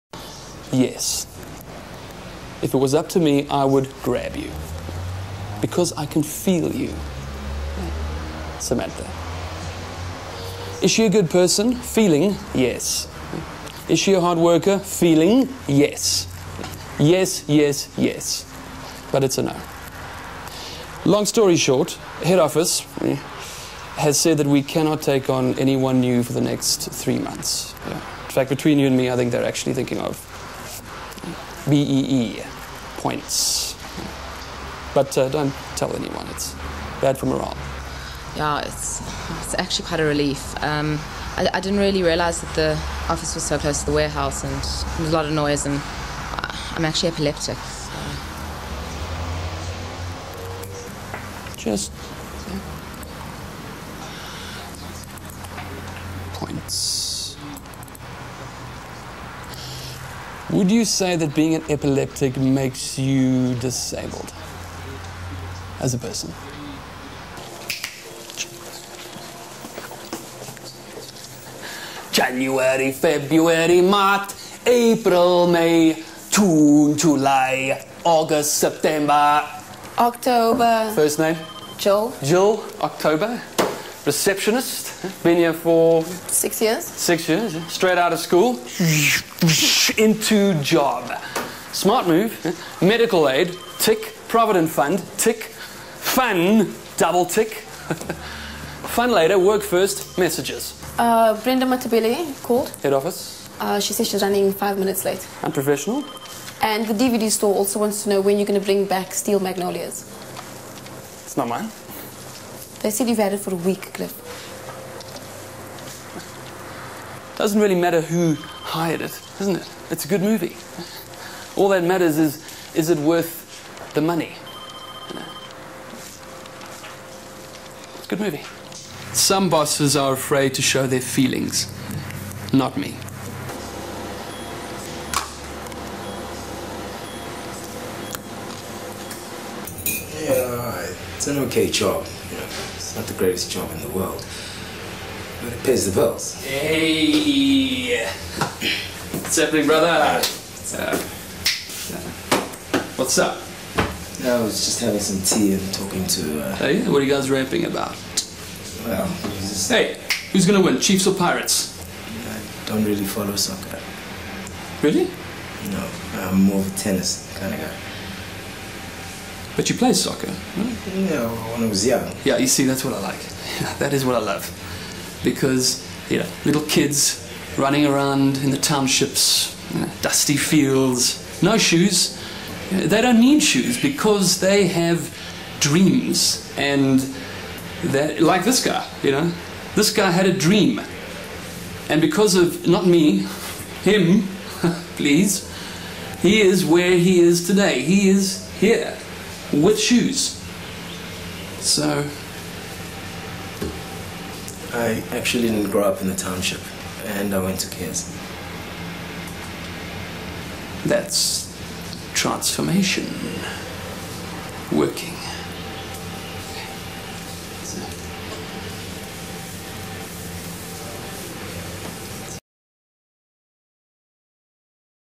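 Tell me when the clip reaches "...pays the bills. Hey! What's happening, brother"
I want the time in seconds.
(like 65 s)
145 s.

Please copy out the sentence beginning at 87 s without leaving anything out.
Straight out of school, into job.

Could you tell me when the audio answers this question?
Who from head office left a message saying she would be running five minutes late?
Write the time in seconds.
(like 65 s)
101 s.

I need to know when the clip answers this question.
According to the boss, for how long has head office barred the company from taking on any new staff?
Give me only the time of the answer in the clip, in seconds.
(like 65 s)
26 s.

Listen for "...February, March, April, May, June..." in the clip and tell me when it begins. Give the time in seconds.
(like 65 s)
72 s.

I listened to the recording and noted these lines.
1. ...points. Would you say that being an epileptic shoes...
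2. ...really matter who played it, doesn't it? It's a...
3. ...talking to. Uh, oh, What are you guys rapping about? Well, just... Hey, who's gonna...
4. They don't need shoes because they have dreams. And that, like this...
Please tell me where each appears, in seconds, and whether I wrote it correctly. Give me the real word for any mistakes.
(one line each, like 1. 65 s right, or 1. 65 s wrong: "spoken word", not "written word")
1. 56 s wrong: "makes", not "shoes"
2. 117 s wrong: "hired", not "played"
3. 155 s right
4. 182 s right.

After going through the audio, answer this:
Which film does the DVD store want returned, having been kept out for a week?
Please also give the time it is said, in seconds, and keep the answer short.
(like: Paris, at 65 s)
Steel Magnolias, at 109 s.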